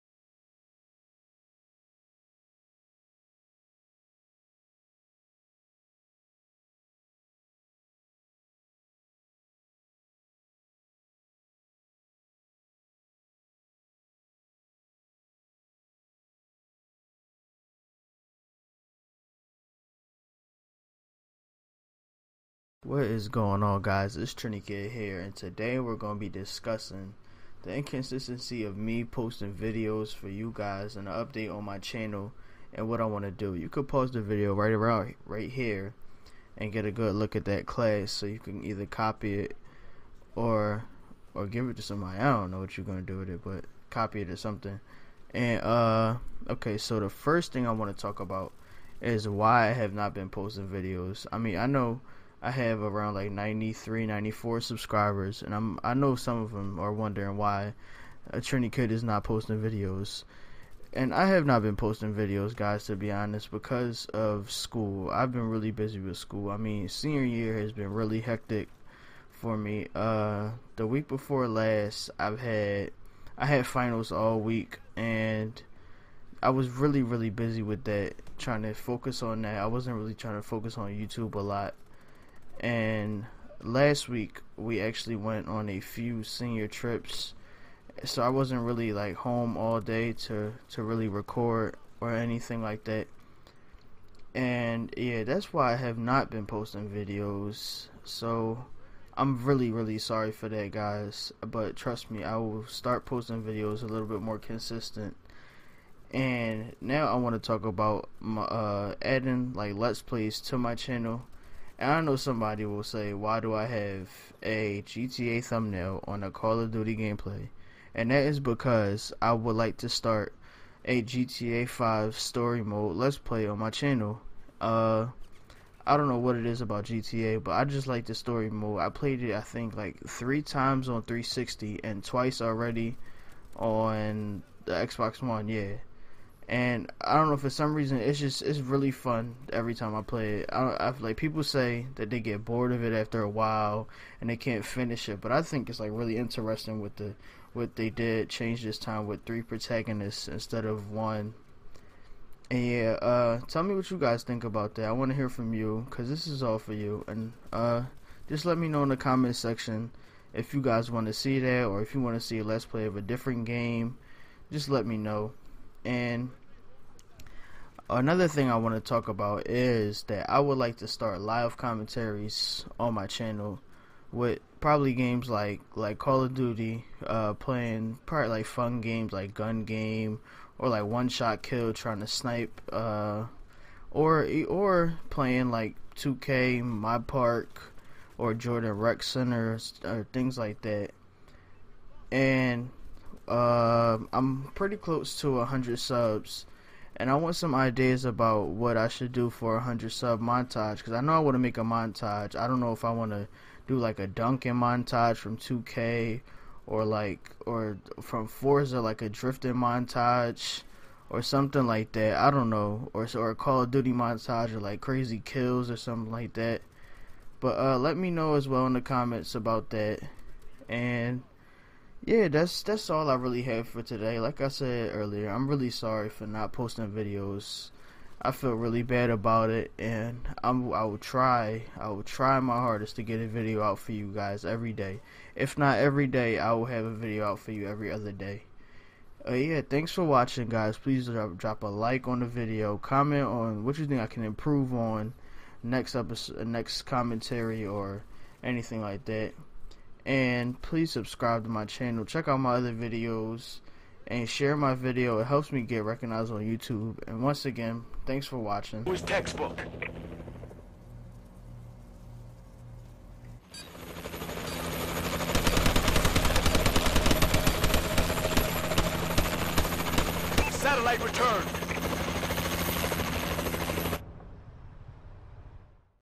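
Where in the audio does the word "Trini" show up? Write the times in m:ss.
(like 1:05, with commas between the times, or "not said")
0:24, 0:58.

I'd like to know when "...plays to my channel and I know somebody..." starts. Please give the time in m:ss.
1:50.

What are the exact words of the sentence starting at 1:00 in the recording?
And I have not been posting videos, guys, to be honest, because of school.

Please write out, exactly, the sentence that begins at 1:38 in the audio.
So I'm really really sorry for that, guys.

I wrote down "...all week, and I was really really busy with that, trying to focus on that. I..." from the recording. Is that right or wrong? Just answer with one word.
right.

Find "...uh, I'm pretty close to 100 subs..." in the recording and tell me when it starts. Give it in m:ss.
3:13.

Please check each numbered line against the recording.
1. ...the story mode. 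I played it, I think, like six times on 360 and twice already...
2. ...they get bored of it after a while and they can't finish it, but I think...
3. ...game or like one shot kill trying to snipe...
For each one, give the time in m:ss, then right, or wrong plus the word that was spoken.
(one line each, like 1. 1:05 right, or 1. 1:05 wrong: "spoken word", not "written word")
1. 2:08 wrong: "three", not "six"
2. 2:22 right
3. 2:59 right.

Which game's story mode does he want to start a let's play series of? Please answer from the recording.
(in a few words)
GTA 5.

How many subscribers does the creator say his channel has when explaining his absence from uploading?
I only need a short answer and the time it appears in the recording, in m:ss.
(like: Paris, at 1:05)
93, 94, at 0:53.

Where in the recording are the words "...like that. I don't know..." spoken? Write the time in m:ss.
3:31.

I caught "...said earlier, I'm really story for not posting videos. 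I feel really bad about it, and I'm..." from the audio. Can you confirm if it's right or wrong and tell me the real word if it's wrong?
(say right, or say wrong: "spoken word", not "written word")
wrong: "sorry", not "story".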